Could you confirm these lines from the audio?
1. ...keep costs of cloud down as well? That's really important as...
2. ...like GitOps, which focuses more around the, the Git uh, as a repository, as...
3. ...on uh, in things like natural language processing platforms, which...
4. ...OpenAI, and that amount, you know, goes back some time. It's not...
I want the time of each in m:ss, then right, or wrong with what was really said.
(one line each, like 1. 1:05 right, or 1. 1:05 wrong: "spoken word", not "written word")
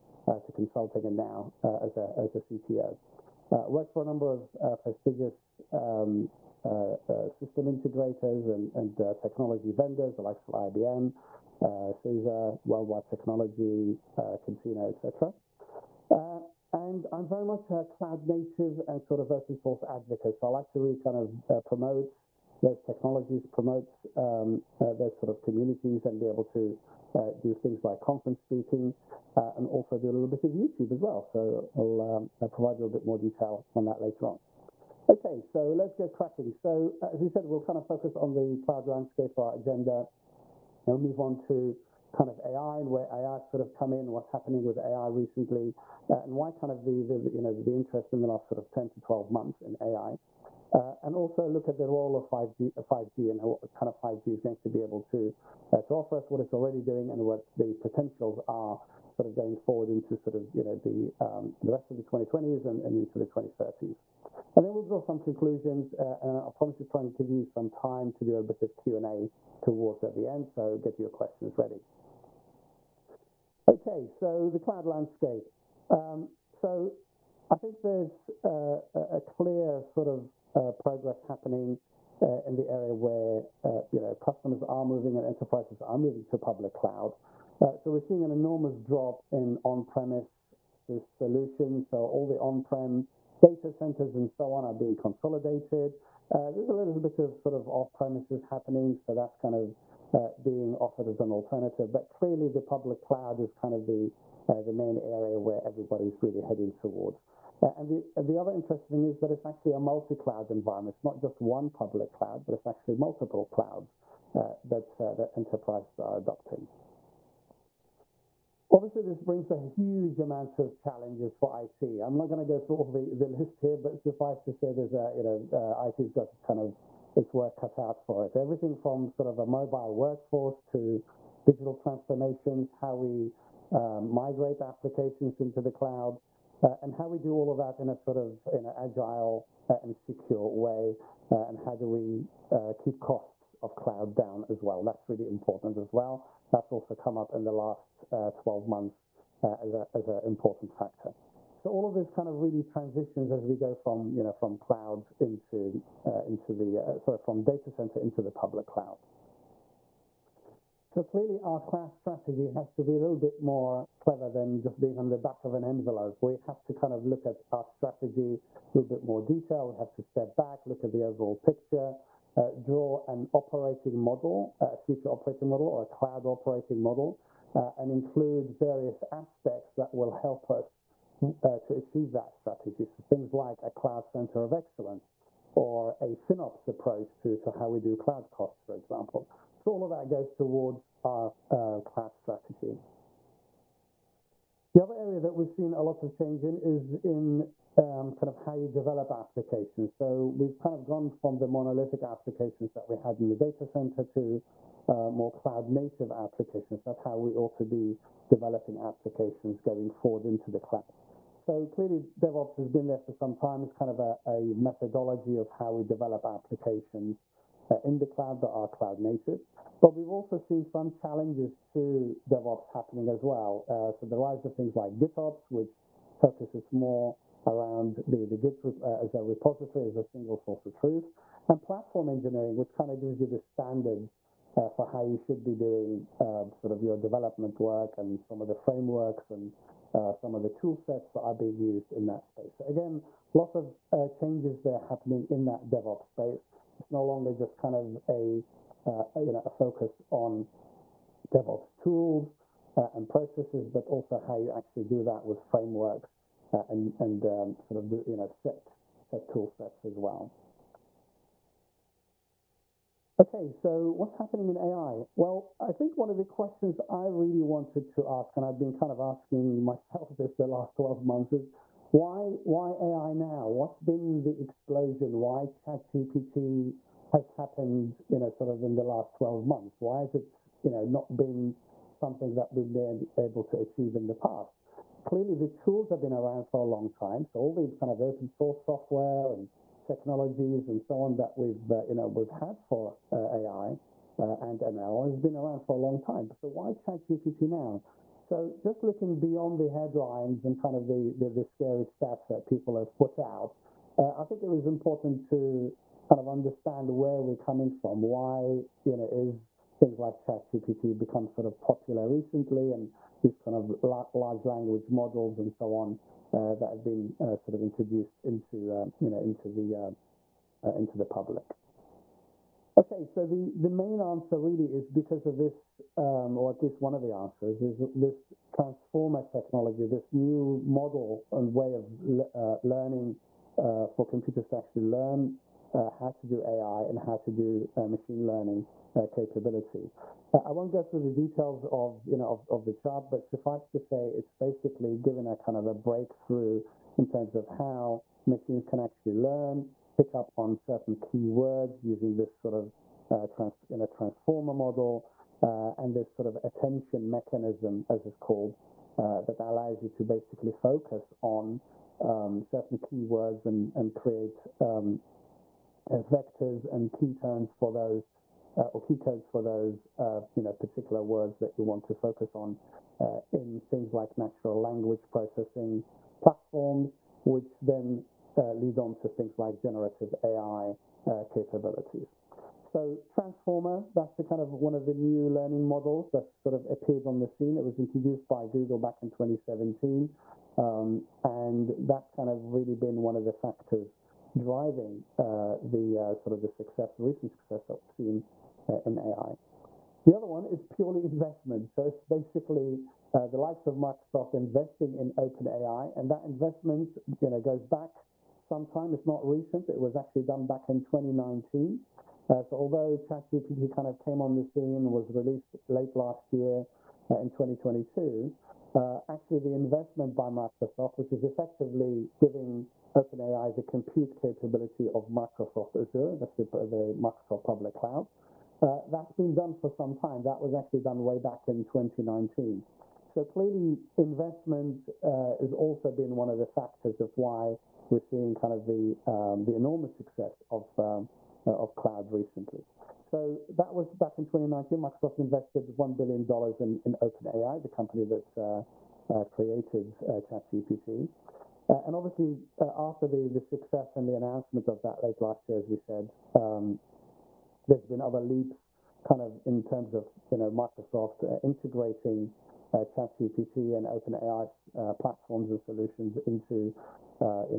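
1. 2:22 right
2. 3:44 right
3. 6:12 right
4. 6:45 wrong: "investment", not "amount".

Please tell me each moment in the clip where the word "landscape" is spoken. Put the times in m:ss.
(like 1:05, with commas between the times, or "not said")
0:38, 1:14.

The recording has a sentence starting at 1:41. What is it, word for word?
But clearly, the public cloud is kind of the uh, the main area where everybody's really heading towards.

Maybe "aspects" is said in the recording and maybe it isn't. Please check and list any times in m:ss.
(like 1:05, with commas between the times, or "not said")
2:59.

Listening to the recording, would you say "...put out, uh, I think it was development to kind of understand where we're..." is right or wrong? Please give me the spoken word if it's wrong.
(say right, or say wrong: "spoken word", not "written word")
wrong: "important", not "development".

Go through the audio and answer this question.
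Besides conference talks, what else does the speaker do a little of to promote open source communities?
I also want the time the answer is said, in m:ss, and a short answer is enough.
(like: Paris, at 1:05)
YouTube, at 0:30.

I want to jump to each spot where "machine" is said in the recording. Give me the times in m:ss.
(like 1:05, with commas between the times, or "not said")
5:37, 5:48.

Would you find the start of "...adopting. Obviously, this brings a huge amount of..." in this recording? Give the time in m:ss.
1:56.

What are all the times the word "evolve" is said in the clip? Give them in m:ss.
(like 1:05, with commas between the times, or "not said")
not said.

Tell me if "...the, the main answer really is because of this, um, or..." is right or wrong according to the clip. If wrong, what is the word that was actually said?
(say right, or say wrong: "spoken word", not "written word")
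right.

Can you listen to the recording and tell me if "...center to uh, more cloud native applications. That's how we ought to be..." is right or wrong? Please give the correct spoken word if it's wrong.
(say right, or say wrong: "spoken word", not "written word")
right.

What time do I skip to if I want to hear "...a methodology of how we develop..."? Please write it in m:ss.
3:34.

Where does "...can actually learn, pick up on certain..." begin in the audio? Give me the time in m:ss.
5:48.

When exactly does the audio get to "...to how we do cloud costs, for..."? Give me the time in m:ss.
3:07.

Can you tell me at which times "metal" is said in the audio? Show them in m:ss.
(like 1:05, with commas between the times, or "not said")
not said.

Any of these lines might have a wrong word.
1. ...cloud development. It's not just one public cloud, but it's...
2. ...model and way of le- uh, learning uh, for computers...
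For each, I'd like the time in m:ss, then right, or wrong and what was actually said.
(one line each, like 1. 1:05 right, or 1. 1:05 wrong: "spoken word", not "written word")
1. 1:50 wrong: "environment", not "development"
2. 5:30 right.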